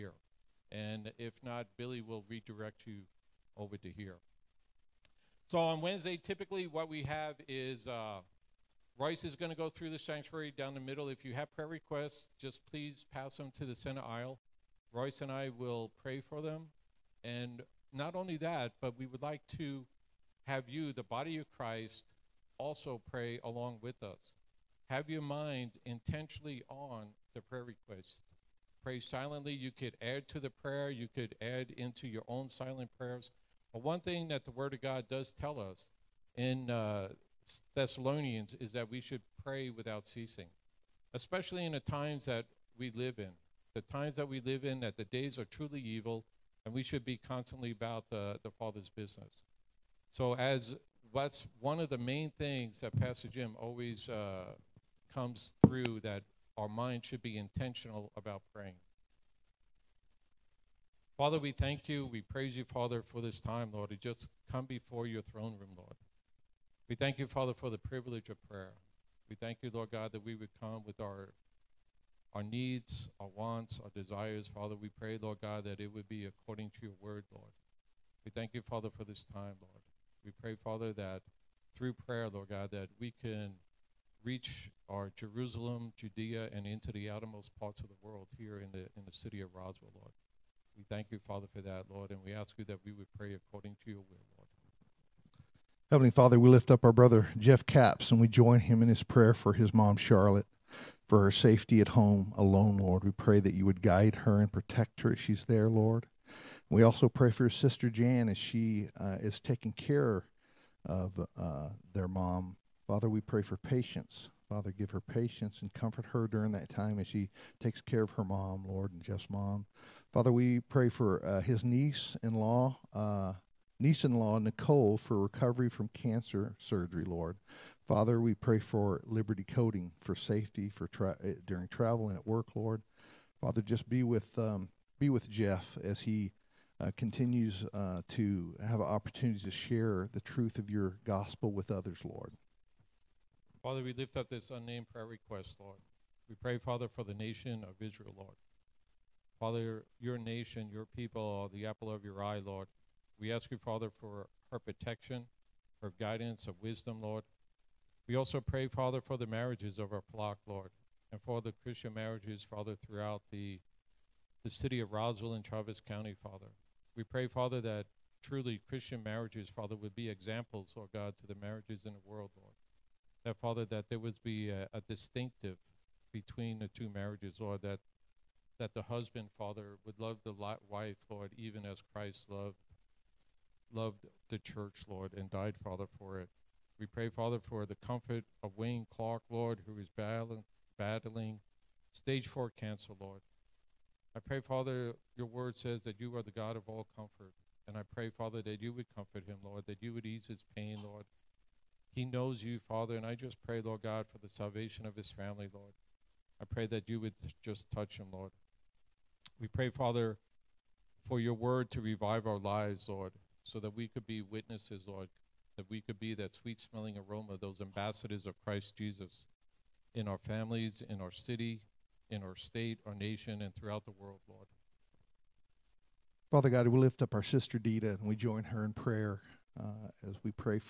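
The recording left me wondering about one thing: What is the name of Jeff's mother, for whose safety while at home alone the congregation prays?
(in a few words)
Charlotte.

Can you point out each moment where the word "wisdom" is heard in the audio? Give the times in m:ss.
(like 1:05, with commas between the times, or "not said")
2:36.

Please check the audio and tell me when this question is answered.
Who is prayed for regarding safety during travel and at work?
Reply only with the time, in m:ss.
2:09.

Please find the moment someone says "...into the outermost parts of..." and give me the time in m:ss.
1:26.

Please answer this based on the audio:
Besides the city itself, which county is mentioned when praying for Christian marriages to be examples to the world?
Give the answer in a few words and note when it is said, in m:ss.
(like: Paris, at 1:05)
Travis County, at 2:45.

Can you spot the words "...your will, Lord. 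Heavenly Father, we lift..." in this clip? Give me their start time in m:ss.
1:33.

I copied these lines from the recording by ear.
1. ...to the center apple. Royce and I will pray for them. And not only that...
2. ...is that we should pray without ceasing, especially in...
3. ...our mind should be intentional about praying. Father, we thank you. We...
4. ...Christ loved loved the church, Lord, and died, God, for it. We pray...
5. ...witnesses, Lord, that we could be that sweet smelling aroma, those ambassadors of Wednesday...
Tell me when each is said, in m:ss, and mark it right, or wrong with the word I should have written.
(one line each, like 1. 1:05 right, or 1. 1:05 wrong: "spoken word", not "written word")
1. 0:13 wrong: "aisle", not "apple"
2. 0:38 right
3. 0:56 right
4. 3:01 wrong: "Father", not "God"
5. 3:34 wrong: "Christ", not "Wednesday".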